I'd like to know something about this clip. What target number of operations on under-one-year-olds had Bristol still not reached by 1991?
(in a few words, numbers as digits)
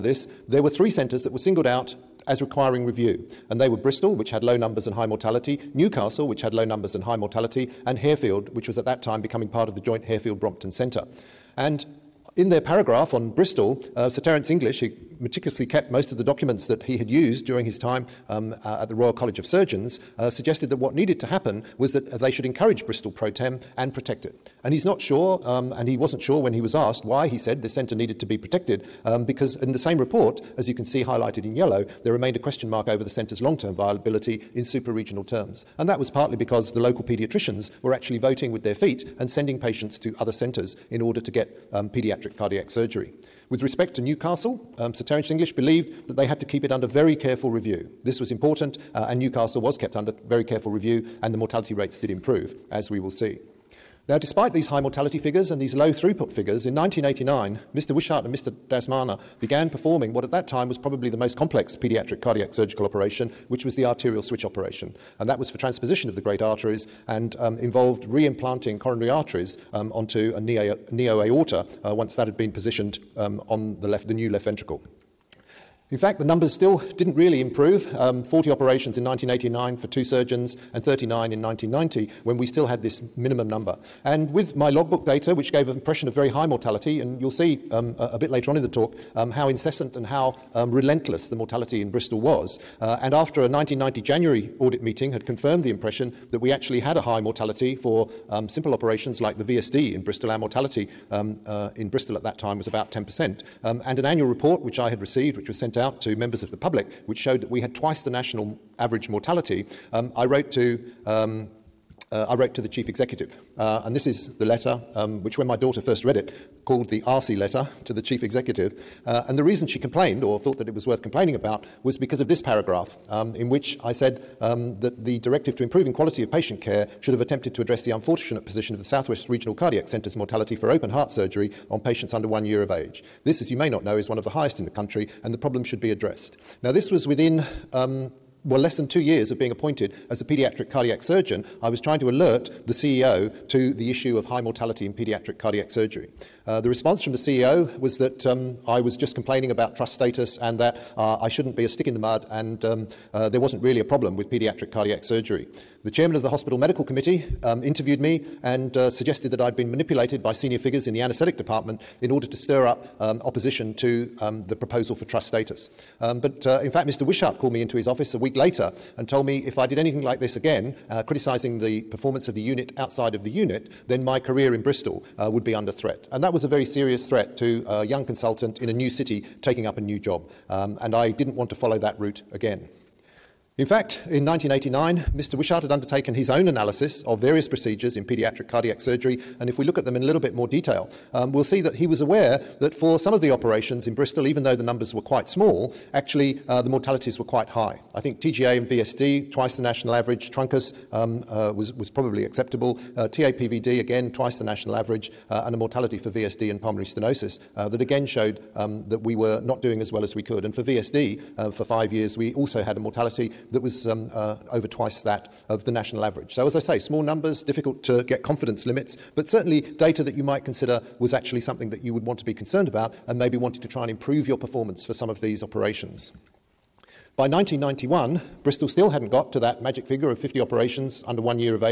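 50.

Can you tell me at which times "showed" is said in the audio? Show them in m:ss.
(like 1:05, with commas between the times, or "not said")
1:47, 3:28.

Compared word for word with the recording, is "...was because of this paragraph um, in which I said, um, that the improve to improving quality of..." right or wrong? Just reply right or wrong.
wrong.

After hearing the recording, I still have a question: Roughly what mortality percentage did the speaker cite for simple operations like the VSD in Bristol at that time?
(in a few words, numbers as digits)
10%.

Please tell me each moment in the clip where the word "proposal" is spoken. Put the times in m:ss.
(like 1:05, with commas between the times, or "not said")
2:44.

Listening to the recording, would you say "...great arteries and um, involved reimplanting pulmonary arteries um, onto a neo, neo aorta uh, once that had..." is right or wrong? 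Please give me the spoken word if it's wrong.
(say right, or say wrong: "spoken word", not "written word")
wrong: "coronary", not "pulmonary".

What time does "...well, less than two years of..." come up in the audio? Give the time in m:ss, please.
2:18.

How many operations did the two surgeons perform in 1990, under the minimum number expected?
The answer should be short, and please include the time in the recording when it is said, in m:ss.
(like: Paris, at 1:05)
39, at 1:20.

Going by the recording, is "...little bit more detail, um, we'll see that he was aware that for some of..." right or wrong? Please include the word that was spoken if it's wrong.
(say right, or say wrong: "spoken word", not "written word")
right.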